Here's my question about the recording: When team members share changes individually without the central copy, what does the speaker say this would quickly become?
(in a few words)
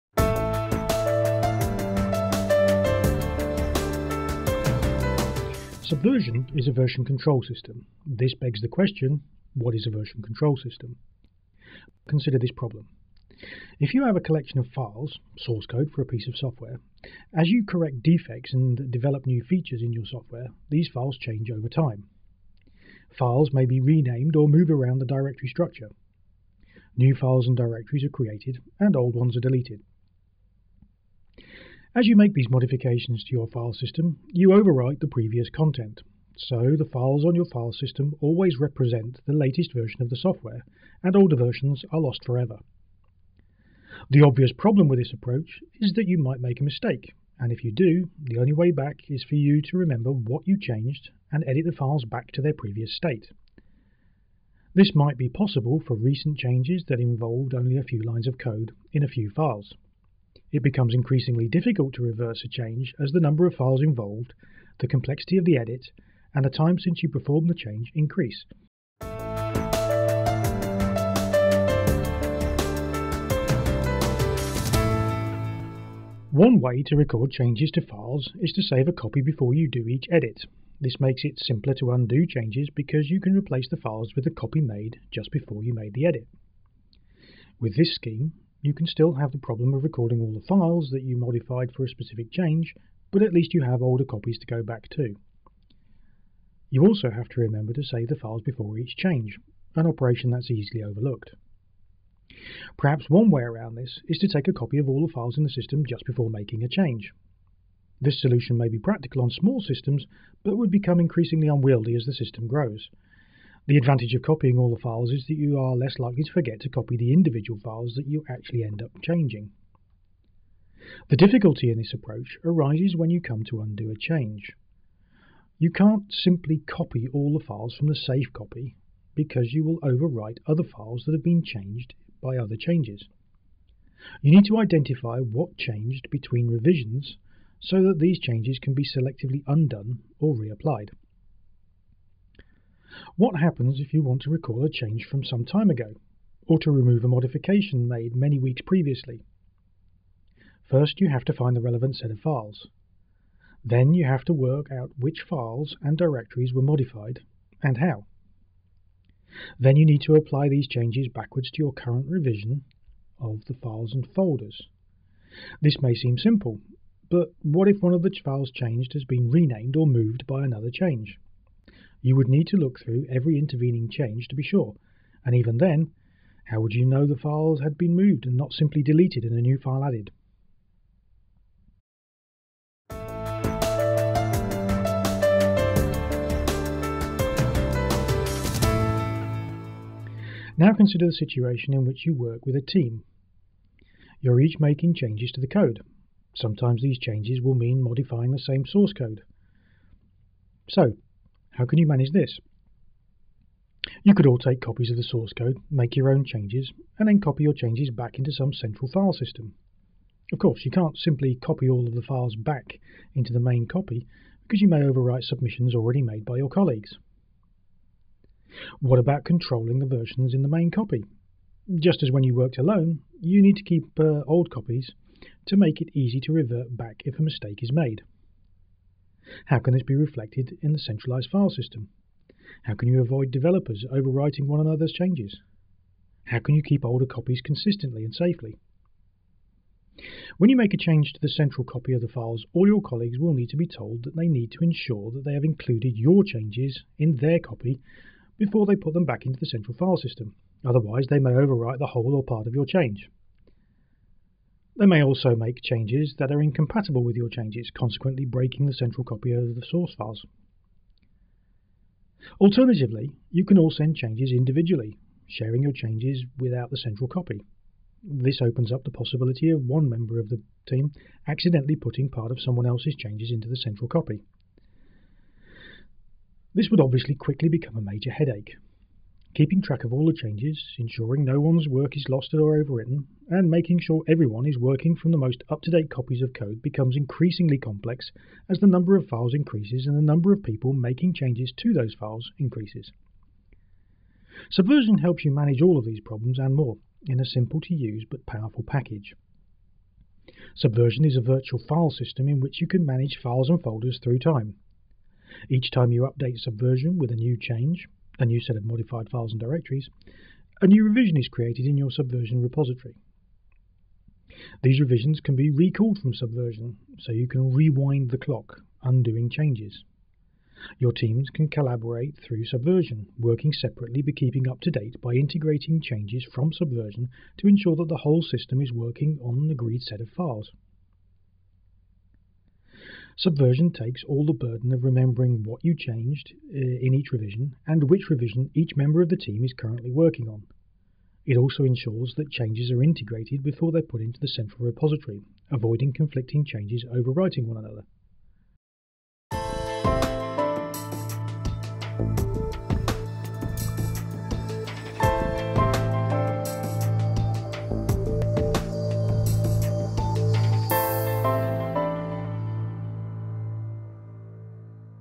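A major headache.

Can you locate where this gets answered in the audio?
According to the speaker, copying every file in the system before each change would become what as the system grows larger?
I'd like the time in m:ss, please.
1:50.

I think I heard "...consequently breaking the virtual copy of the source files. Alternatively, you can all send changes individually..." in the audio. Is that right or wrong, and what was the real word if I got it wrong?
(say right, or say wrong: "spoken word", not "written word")
wrong: "central", not "virtual".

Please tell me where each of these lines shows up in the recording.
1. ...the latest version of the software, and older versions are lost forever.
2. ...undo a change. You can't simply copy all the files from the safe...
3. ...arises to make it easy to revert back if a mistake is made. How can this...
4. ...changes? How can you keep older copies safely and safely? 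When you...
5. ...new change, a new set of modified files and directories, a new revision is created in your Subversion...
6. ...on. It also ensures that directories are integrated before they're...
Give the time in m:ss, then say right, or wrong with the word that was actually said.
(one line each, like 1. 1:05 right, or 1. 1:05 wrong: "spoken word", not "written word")
1. 0:39 right
2. 2:03 right
3. 3:44 wrong: "copies", not "arises"
4. 3:54 wrong: "consistently", not "safely"
5. 5:07 right
6. 5:40 wrong: "changes", not "directories".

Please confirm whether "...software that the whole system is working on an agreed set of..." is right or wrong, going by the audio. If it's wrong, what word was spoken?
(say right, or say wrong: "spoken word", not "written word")
wrong: "ensure", not "software".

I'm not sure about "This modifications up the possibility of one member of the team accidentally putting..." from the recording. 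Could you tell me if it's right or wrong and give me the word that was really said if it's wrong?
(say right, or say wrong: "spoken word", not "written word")
wrong: "opens", not "modifications".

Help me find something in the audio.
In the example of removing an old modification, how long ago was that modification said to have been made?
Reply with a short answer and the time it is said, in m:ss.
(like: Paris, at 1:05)
Many weeks previously, at 2:28.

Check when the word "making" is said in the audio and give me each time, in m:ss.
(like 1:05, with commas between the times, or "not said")
1:46, 3:14, 4:43, 4:50.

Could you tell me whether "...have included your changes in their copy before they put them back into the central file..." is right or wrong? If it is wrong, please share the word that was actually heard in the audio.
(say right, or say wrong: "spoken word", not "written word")
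right.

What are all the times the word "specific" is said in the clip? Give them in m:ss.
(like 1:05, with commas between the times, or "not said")
1:31.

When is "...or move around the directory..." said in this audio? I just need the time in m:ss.
0:24.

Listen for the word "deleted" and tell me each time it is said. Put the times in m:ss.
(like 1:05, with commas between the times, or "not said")
0:29, 2:58.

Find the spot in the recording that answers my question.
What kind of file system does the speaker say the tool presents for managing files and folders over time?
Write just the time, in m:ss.
5:01.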